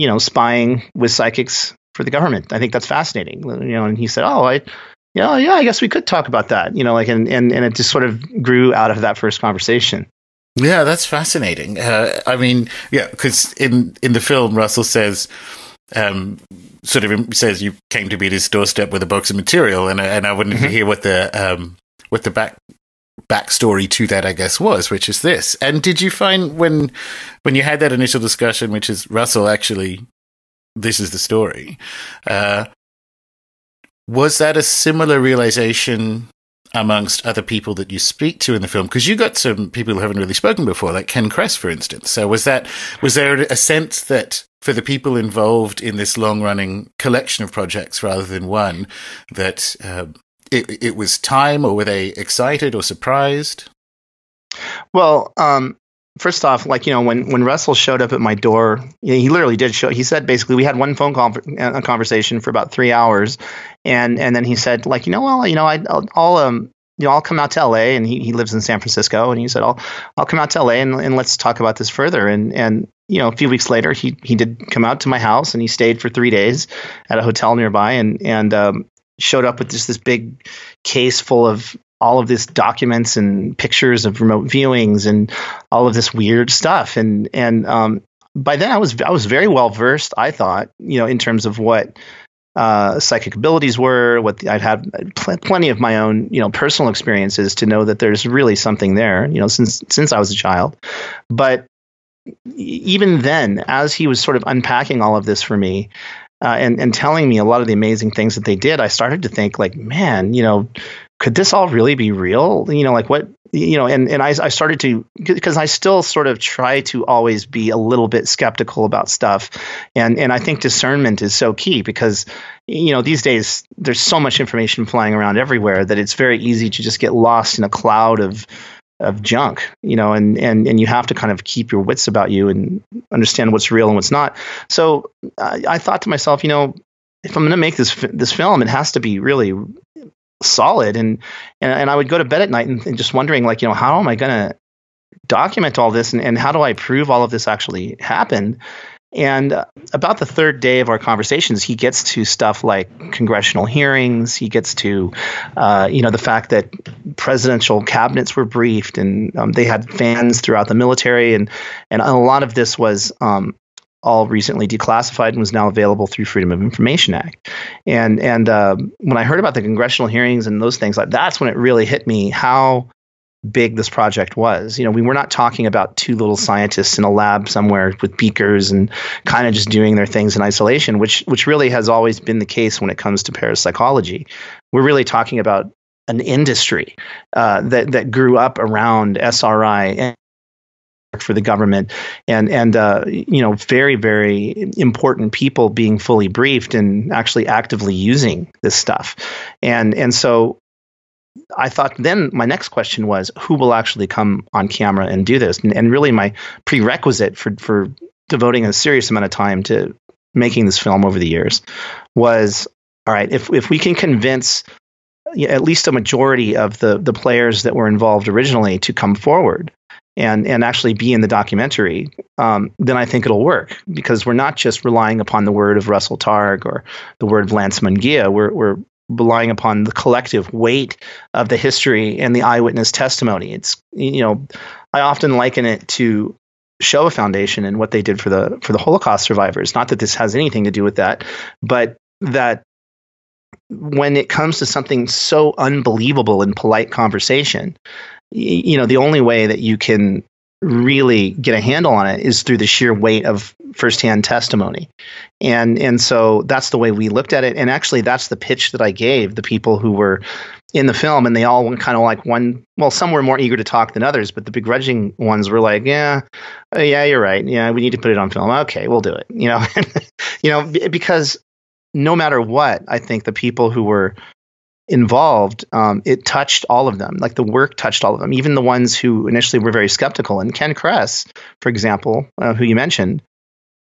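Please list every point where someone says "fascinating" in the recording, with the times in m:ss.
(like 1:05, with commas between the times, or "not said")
0:02, 0:11.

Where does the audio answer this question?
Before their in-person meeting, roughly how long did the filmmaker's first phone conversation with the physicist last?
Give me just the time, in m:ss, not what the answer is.
1:02.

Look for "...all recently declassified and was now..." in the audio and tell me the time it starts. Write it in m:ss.
2:44.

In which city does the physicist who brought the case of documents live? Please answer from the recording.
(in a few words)
San Francisco.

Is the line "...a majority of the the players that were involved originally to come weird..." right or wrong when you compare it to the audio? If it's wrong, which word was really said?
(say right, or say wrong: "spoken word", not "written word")
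wrong: "forward", not "weird".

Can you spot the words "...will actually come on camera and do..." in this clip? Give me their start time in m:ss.
3:23.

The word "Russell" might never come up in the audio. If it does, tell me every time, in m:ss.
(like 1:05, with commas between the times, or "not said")
0:14, 0:29, 0:57, 3:45.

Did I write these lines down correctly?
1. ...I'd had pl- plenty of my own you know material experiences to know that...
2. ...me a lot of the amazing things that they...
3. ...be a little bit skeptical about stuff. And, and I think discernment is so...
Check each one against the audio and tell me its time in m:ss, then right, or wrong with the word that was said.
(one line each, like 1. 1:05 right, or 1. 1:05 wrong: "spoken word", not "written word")
1. 1:34 wrong: "personal", not "material"
2. 1:47 right
3. 1:57 right.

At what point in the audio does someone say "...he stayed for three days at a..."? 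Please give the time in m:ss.
1:15.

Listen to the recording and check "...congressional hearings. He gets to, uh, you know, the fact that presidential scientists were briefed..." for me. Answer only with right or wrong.
wrong.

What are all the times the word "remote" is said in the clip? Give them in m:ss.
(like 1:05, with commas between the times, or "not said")
1:24.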